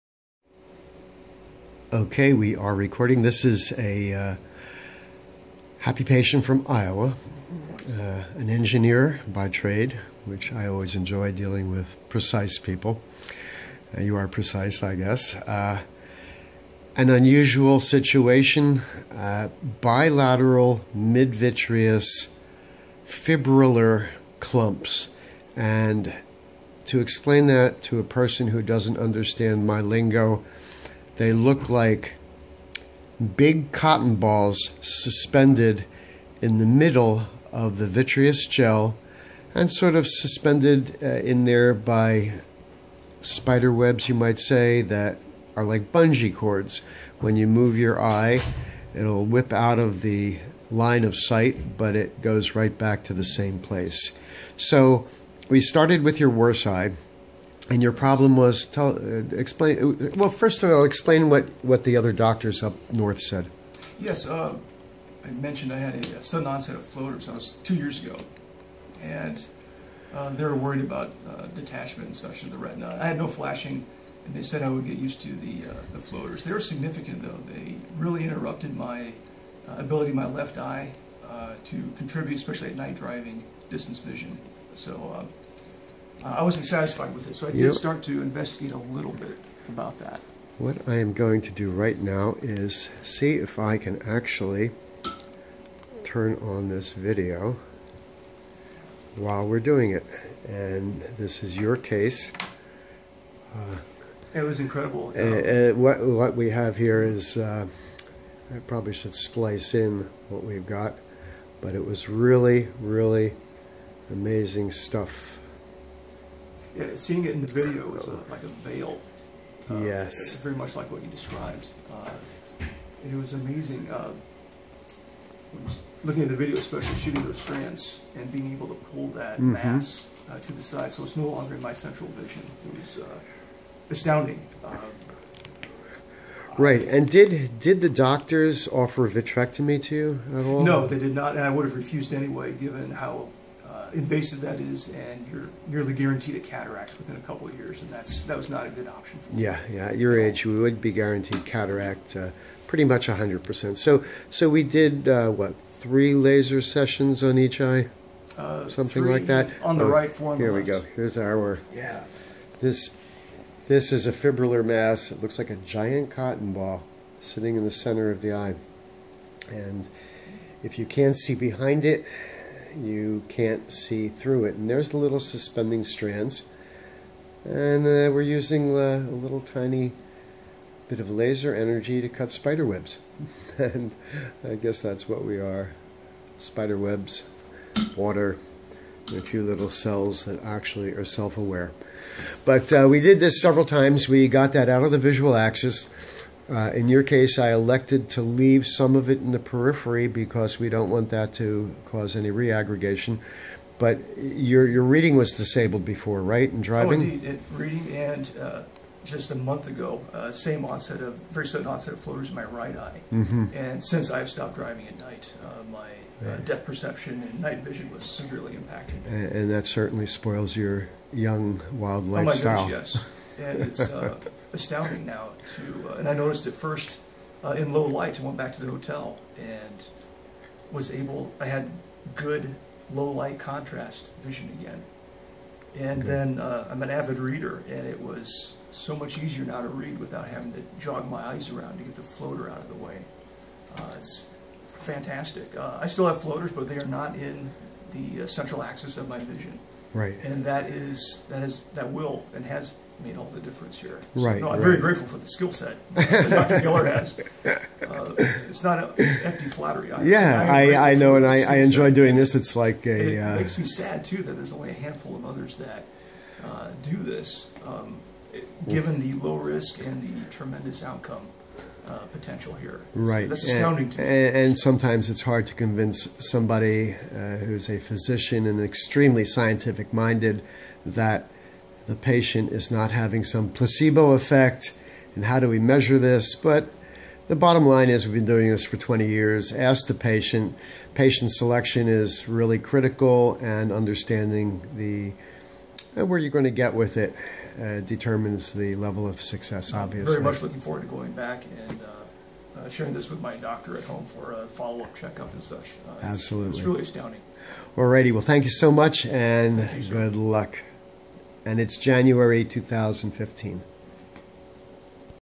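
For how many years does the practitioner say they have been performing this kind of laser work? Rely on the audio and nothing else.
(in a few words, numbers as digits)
20.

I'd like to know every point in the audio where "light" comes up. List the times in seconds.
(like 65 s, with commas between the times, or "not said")
227 s, 233 s.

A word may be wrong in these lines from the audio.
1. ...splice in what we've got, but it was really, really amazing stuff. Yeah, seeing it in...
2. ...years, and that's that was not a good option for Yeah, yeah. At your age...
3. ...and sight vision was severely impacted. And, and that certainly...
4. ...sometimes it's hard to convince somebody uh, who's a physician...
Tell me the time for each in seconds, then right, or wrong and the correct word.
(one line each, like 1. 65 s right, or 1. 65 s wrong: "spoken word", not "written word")
1. 109 s right
2. 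147 s right
3. 217 s wrong: "night", not "sight"
4. 274 s right.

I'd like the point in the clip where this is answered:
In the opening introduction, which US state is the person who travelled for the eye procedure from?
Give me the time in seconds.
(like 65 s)
6 s.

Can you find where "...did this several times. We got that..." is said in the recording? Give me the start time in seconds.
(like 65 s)
192 s.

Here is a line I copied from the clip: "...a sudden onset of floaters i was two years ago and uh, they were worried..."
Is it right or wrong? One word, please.
right.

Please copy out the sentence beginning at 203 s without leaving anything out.
But your your reading was disabled before, right?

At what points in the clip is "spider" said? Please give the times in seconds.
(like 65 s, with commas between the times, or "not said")
43 s, 182 s, 186 s.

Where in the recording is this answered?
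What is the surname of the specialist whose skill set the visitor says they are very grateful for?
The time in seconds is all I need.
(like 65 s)
256 s.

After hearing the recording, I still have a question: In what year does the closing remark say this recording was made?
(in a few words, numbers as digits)
2015.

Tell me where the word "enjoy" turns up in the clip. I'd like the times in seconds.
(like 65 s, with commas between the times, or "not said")
10 s, 261 s.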